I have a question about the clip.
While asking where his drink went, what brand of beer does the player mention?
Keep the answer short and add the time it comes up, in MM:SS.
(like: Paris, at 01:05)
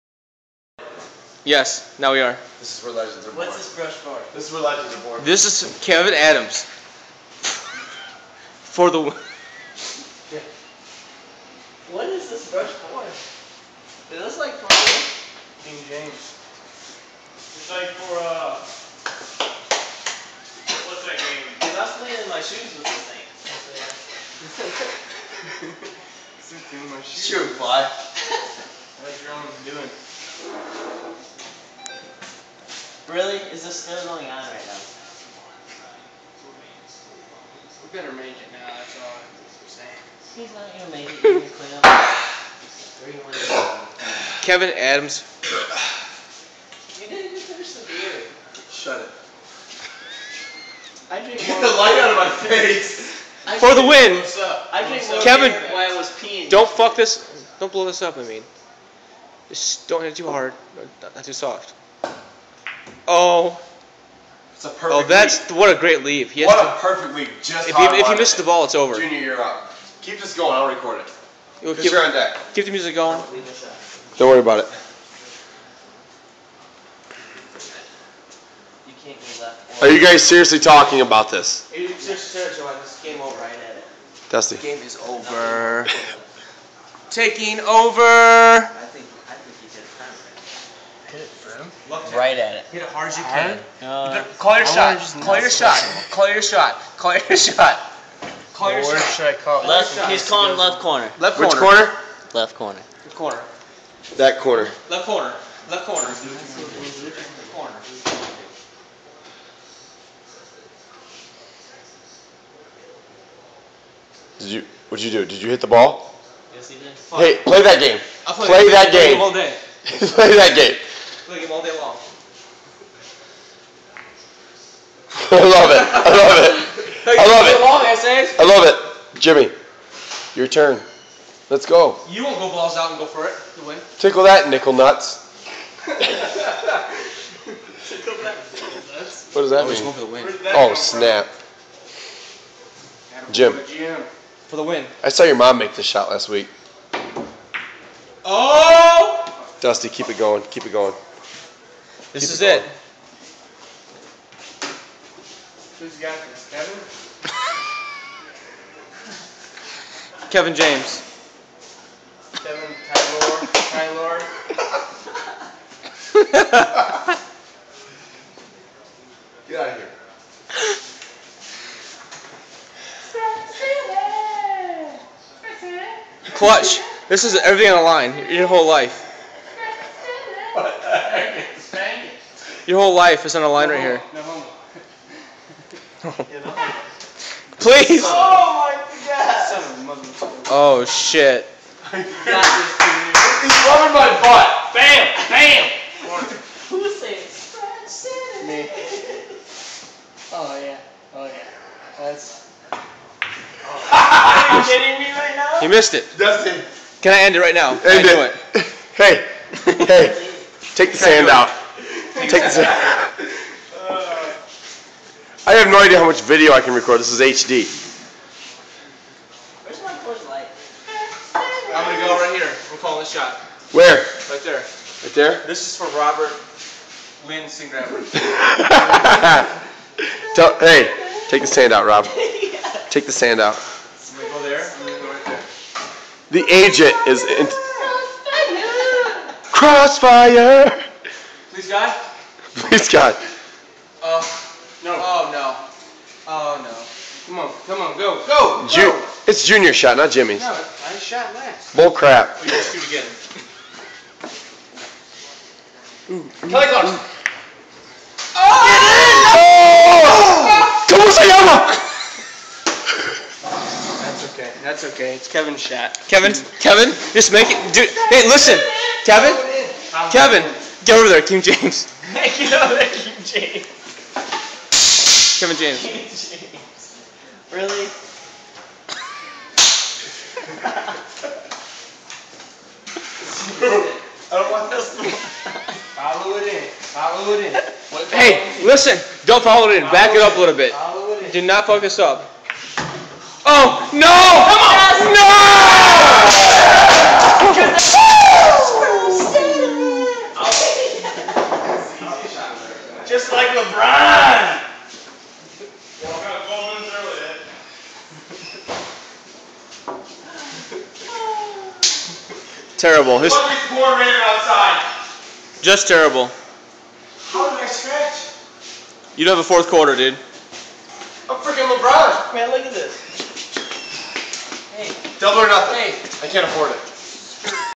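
Coors Light, at 03:40.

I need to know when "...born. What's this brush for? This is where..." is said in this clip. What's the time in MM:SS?
00:03.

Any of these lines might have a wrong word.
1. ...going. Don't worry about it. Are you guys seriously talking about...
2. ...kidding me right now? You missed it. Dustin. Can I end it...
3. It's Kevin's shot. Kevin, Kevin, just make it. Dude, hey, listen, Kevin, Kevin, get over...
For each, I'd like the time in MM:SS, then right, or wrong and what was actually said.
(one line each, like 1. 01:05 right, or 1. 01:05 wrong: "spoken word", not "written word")
1. 01:12 right
2. 03:24 right
3. 04:25 right.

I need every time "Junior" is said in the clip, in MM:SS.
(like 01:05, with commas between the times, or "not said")
01:08, 04:09.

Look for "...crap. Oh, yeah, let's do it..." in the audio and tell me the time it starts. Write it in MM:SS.
04:11.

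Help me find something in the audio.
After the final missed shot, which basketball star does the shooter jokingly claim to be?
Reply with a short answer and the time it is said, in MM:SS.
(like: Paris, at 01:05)
LeBron, at 05:21.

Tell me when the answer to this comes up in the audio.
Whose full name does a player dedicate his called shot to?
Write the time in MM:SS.
03:45.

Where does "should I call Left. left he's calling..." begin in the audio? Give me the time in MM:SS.
01:38.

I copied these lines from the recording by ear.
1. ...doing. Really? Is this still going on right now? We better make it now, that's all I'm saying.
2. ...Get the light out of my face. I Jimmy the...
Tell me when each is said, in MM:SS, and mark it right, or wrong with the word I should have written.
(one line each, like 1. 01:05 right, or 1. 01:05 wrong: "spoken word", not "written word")
1. 00:30 right
2. 00:51 wrong: "For", not "Jimmy".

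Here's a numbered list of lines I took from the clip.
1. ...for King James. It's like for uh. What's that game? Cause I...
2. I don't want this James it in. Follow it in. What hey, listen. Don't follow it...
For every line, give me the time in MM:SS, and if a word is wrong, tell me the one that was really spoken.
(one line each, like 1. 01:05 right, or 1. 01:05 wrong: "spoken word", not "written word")
1. 00:14 right
2. 04:43 wrong: "Follow", not "James".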